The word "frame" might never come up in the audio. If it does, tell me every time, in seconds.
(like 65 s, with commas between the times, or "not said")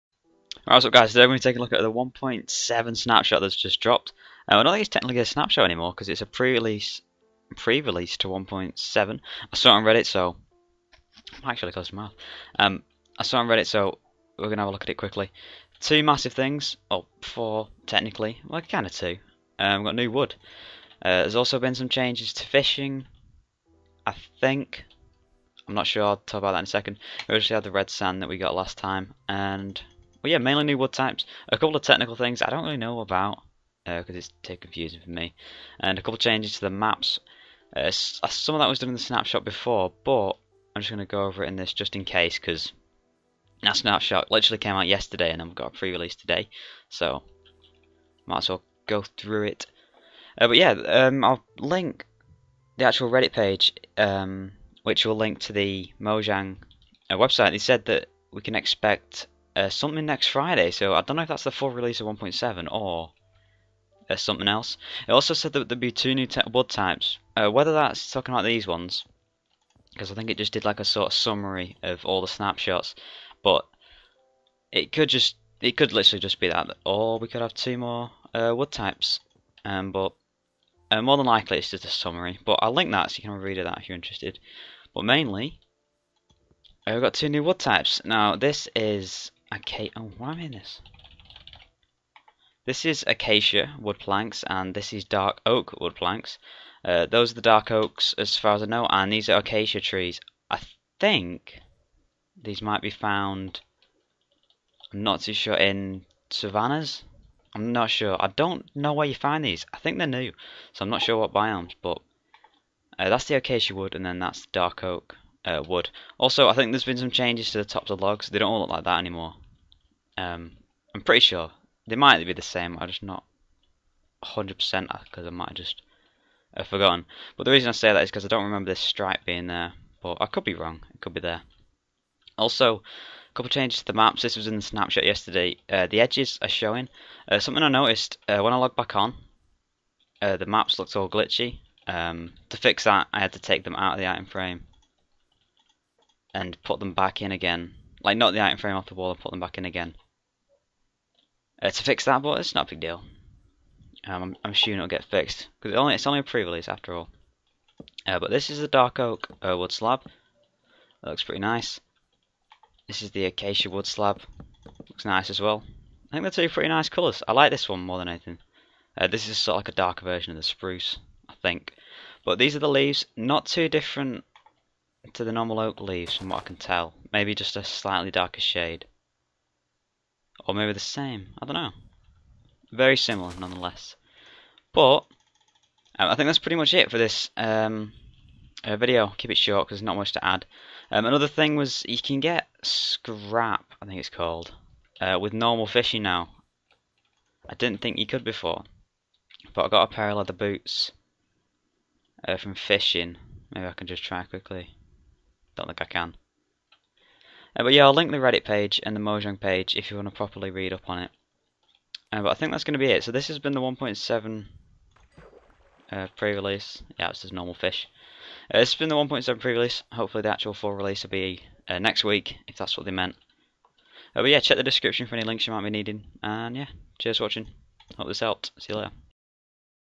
144 s, 148 s.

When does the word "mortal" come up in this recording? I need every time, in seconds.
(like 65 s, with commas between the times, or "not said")
not said.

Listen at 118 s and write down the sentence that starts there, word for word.
They don't all look like that anymore.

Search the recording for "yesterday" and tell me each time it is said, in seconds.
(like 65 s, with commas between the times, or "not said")
44 s, 135 s.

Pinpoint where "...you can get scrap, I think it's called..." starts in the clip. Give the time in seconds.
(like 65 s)
191 s.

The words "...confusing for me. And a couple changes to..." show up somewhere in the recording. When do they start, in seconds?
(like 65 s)
34 s.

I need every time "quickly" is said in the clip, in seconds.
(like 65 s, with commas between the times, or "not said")
14 s, 204 s.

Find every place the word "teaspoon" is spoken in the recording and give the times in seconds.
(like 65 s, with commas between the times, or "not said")
not said.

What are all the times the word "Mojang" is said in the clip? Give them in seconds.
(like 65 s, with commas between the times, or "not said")
55 s, 209 s.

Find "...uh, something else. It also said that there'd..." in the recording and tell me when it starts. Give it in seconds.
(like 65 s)
64 s.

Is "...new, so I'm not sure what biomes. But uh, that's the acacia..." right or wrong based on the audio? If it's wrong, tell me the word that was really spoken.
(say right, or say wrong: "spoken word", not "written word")
right.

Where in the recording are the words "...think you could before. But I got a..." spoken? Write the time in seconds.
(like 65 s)
197 s.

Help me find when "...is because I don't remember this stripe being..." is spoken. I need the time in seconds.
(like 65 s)
128 s.